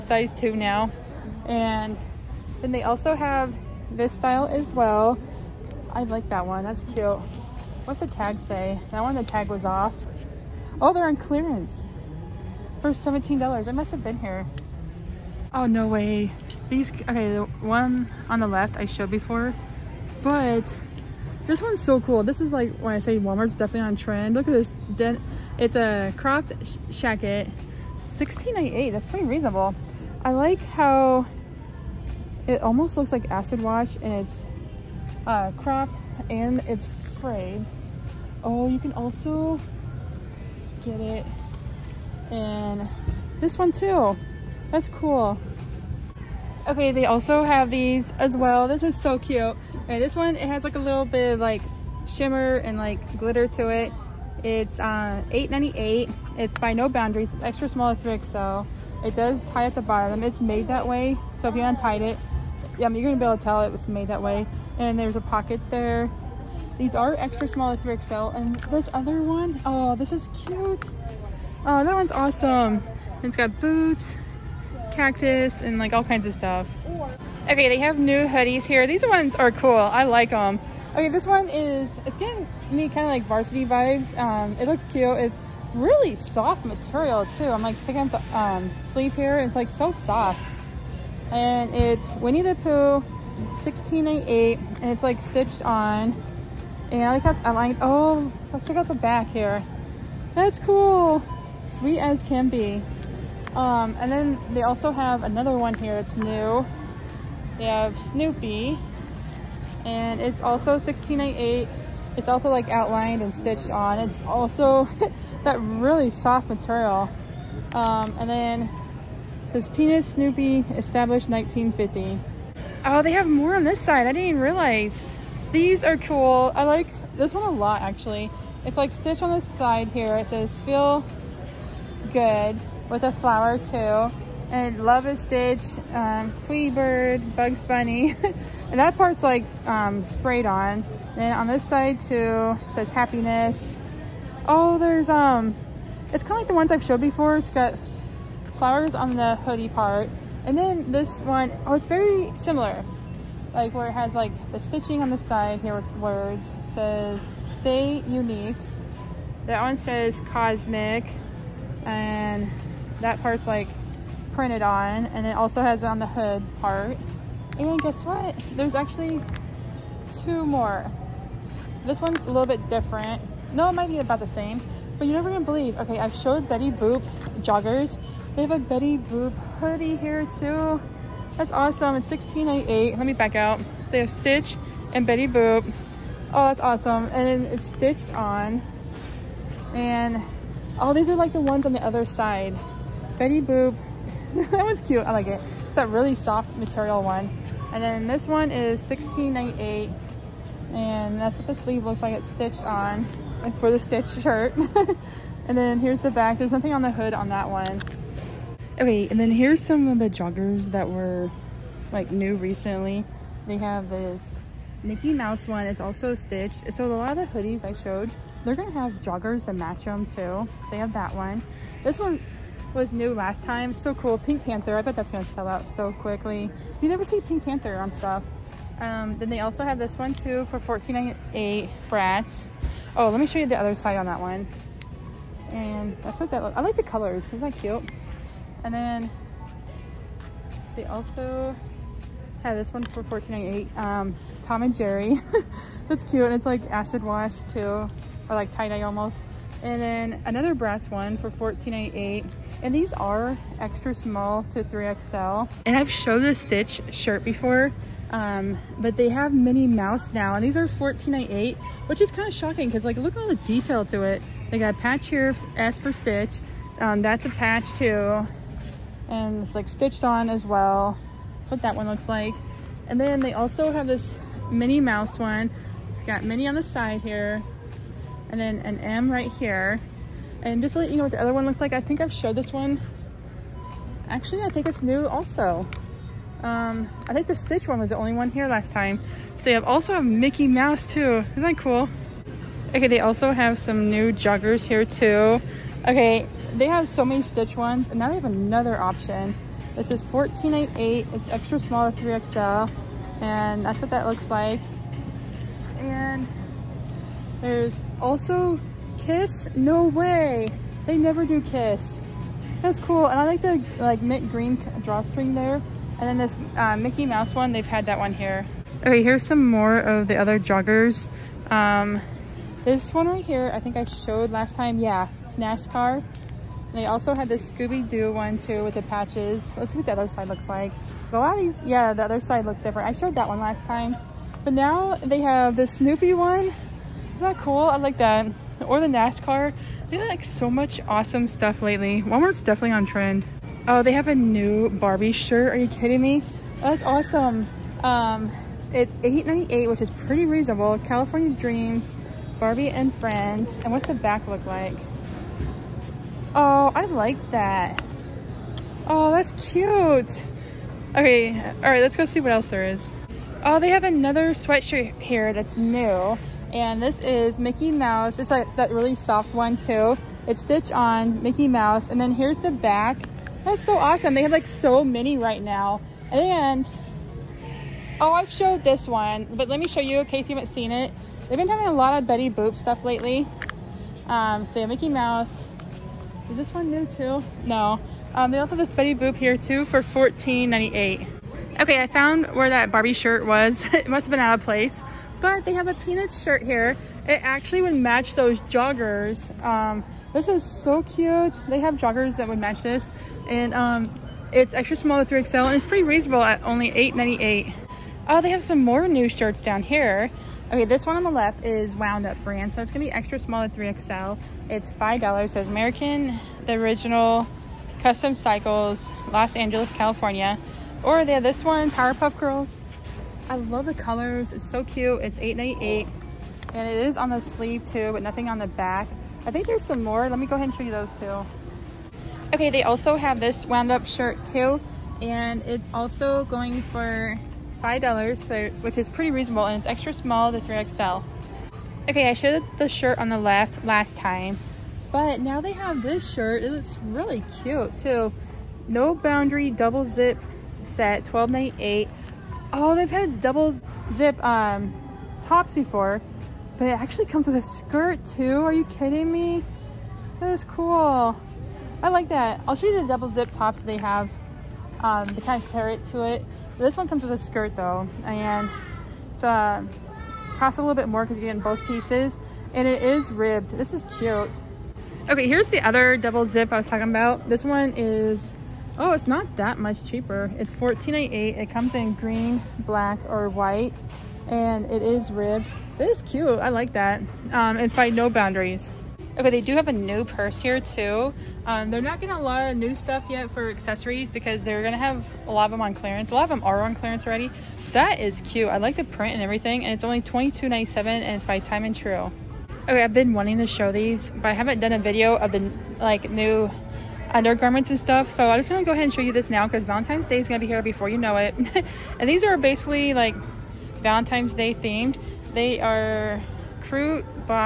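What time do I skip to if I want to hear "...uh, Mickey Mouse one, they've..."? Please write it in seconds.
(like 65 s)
316 s.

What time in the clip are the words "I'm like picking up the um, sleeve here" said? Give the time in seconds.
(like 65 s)
87 s.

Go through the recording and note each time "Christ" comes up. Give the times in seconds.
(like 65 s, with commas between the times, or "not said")
not said.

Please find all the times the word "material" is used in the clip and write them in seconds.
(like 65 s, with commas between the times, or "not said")
86 s, 116 s, 196 s.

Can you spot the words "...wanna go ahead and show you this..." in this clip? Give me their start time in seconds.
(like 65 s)
508 s.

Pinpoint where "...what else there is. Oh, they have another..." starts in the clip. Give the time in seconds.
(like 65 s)
362 s.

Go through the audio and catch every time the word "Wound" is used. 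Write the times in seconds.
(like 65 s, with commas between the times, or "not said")
411 s, 433 s.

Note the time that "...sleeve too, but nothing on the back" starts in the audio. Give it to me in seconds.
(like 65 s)
427 s.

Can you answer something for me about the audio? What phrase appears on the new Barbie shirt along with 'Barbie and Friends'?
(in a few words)
California Dream.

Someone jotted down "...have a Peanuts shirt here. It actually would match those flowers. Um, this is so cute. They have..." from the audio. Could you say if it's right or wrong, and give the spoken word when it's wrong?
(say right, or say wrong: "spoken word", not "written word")
wrong: "joggers", not "flowers".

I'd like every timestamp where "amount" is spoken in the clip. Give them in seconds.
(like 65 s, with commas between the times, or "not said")
not said.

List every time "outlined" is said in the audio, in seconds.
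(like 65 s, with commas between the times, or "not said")
112 s.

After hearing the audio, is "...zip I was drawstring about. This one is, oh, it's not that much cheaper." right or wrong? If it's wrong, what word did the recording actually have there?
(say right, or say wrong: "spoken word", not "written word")
wrong: "talking", not "drawstring".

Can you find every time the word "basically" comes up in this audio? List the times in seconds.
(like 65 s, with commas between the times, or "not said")
512 s.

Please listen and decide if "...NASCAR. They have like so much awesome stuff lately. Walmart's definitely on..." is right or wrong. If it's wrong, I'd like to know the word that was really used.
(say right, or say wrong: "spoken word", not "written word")
right.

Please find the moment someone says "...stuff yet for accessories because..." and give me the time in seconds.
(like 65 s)
492 s.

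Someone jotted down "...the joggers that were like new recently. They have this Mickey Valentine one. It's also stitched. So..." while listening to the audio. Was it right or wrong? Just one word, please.
wrong.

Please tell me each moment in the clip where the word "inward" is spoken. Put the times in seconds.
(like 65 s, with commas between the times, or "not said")
not said.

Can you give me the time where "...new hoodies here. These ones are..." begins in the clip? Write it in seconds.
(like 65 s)
77 s.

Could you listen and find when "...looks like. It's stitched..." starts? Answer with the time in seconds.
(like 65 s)
201 s.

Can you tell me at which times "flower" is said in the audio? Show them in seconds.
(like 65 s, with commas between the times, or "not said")
133 s, 148 s.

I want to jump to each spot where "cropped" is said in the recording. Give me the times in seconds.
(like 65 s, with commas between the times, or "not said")
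26 s, 35 s.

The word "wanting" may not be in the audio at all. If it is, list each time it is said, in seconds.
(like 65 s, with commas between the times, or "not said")
503 s.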